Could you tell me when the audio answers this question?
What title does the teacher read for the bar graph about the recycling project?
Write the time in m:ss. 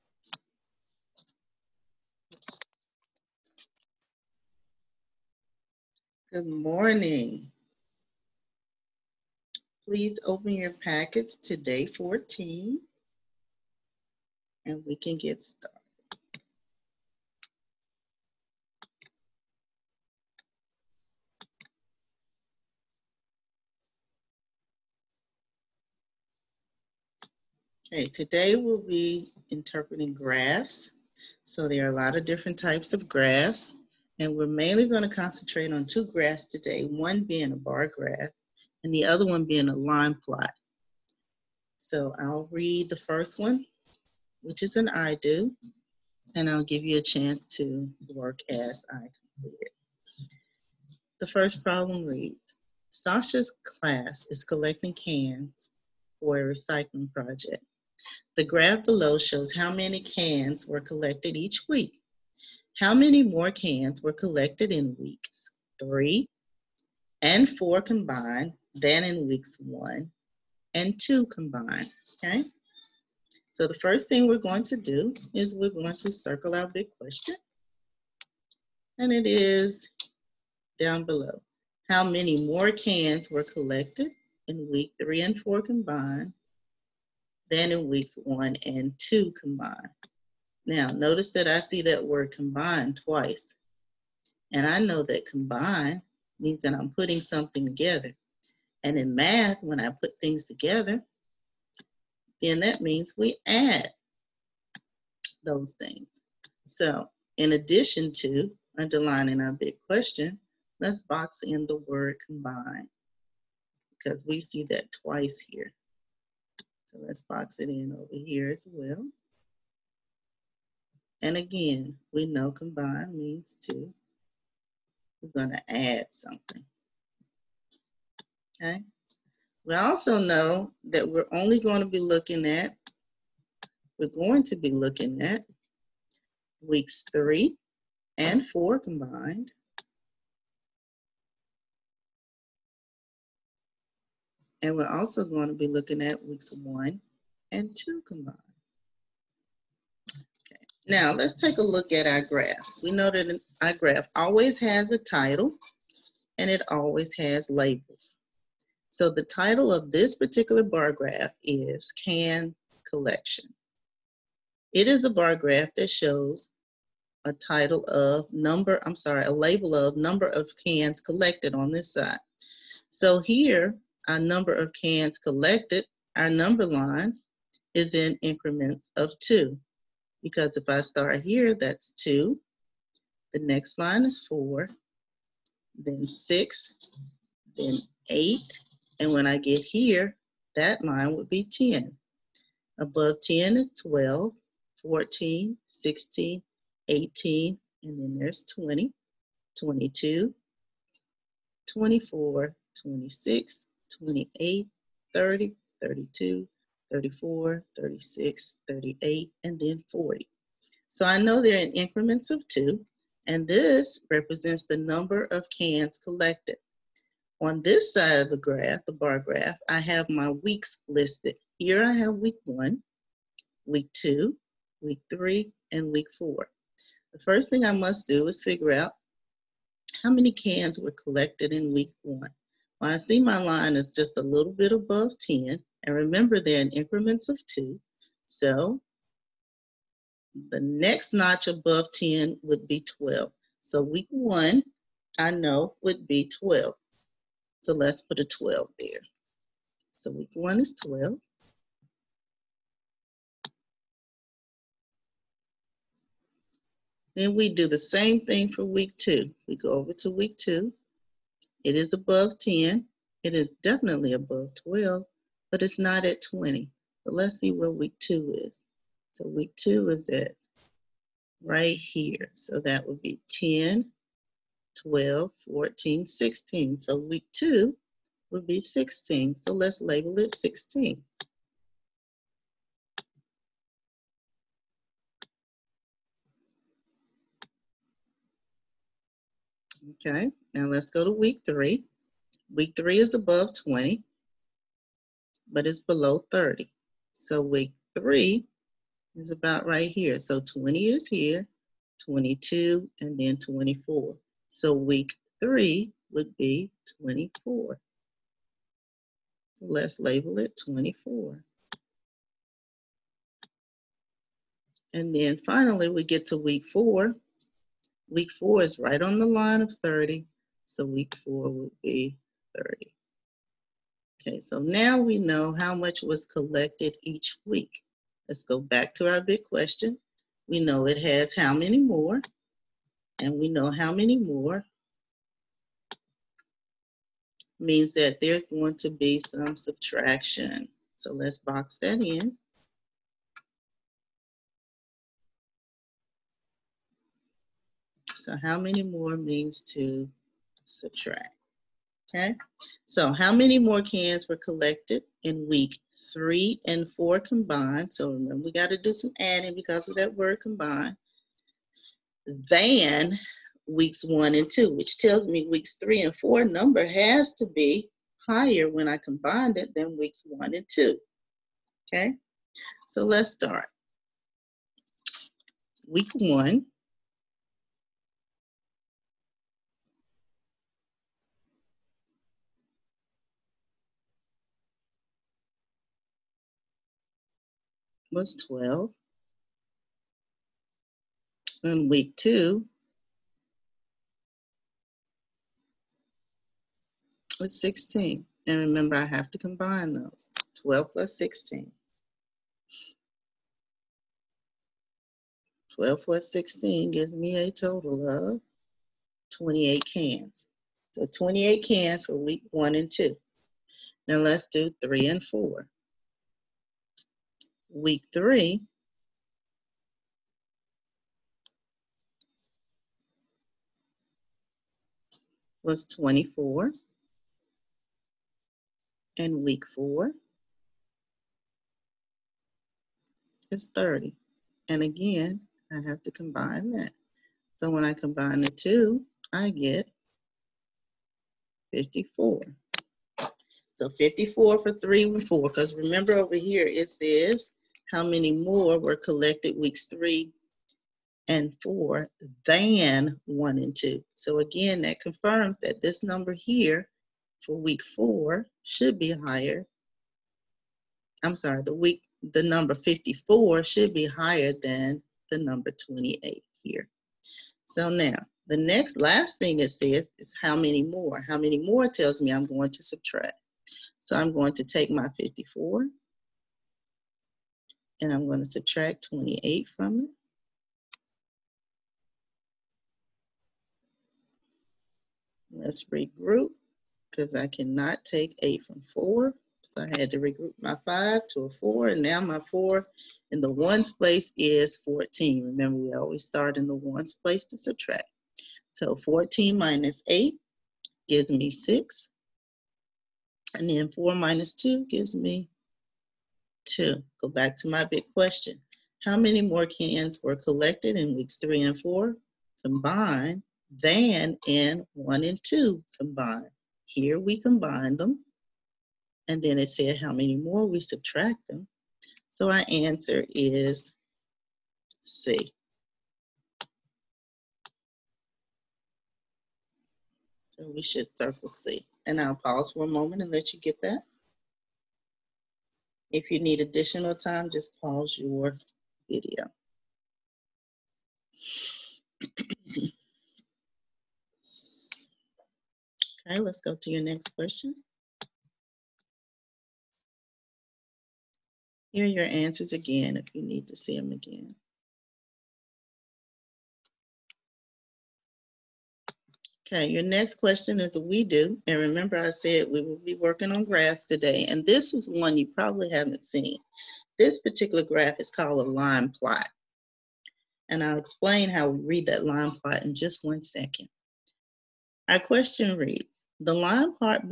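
2:42.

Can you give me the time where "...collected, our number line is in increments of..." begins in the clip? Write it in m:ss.
2:55.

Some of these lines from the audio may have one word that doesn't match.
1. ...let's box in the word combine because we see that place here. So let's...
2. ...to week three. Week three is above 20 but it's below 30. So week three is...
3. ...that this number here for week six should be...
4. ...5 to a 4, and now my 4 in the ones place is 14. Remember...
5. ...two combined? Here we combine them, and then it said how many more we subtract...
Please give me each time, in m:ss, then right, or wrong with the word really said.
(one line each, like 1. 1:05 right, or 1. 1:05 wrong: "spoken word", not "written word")
1. 1:50 wrong: "twice", not "place"
2. 4:51 right
3. 7:35 wrong: "four", not "six"
4. 8:10 right
5. 8:35 right.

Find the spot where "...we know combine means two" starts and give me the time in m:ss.
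2:02.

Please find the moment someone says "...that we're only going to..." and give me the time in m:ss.
2:10.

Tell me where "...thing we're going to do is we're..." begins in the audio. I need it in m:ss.
1:14.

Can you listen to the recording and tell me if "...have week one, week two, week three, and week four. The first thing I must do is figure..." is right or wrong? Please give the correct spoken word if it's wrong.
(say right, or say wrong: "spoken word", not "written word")
right.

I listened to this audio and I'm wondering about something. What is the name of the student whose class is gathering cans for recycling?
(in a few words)
Sasha.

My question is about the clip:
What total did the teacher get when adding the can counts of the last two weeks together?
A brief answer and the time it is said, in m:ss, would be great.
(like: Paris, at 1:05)
54, at 7:19.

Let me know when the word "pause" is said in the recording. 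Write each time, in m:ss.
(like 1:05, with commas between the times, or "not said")
8:52, 8:57.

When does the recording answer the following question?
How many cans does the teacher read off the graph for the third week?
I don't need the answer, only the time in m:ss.
5:06.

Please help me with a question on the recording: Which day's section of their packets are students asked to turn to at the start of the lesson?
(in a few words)
Day 14.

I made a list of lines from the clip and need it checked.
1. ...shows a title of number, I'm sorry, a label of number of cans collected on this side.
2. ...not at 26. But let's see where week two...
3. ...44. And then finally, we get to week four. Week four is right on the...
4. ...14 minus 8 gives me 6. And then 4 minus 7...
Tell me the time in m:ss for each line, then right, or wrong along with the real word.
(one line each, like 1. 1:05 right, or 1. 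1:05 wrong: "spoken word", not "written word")
1. 2:45 right
2. 4:25 wrong: "20", not "26"
3. 5:10 wrong: "24", not "44"
4. 8:18 wrong: "2", not "7".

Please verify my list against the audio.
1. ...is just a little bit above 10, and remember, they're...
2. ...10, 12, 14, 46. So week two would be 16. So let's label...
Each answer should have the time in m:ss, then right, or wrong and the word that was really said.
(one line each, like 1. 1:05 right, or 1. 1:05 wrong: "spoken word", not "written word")
1. 3:53 right
2. 4:33 wrong: "16", not "46".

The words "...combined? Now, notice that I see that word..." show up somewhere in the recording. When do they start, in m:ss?
1:29.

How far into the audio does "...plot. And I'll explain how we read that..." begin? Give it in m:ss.
9:29.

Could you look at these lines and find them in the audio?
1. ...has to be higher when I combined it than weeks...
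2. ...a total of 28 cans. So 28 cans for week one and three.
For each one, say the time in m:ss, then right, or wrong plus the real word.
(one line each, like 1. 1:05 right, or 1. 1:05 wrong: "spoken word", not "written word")
1. 6:06 right
2. 6:47 wrong: "two", not "three".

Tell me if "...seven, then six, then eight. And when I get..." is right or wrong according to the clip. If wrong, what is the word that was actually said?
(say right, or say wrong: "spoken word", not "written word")
wrong: "four", not "seven".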